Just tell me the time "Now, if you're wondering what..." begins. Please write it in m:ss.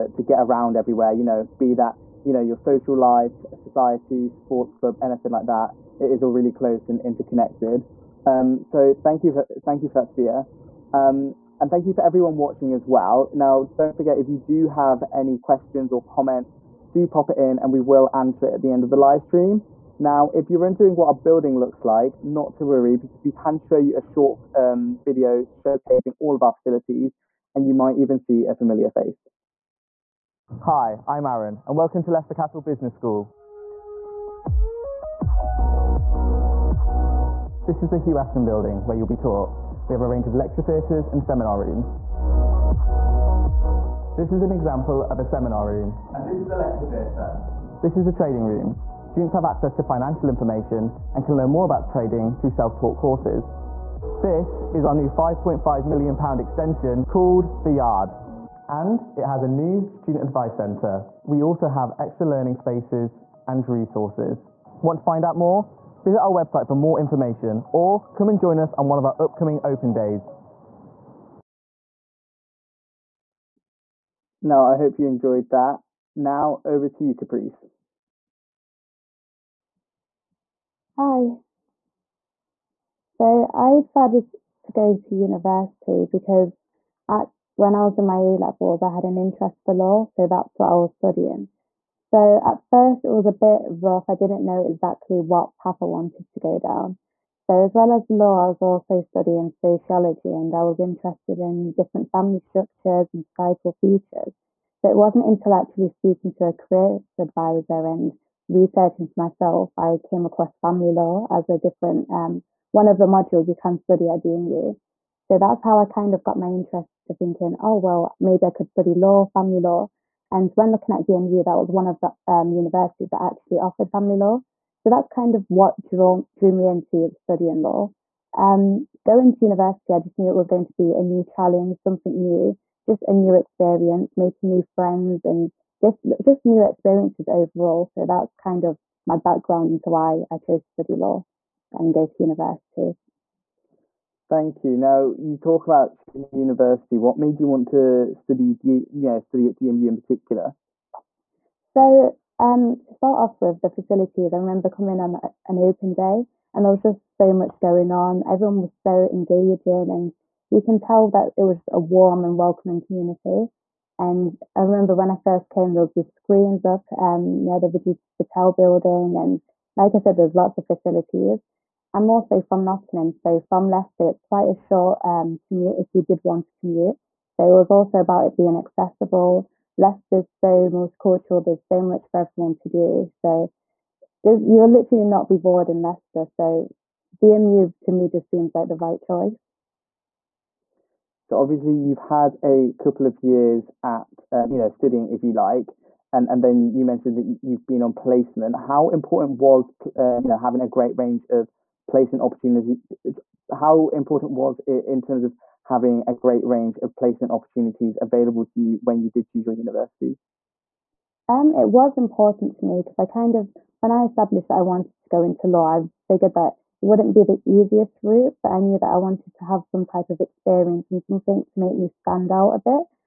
0:19.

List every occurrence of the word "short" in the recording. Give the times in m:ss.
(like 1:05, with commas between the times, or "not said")
0:24, 2:54.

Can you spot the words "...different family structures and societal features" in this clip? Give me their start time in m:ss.
1:41.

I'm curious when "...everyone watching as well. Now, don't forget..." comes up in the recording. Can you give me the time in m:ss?
0:12.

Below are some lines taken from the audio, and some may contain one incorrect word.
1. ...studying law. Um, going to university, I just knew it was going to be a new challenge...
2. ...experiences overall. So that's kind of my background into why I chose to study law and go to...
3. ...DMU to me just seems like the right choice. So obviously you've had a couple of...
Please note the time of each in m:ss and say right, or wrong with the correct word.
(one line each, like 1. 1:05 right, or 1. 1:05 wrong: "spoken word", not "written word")
1. 2:07 right
2. 2:16 right
3. 3:07 right.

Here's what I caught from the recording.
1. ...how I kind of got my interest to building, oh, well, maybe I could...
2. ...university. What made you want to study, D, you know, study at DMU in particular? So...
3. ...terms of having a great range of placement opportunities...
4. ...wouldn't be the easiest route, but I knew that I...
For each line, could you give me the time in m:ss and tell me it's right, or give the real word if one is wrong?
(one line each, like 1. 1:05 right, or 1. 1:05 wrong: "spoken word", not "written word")
1. 1:55 wrong: "thinking", not "building"
2. 2:26 right
3. 3:25 right
4. 3:36 right.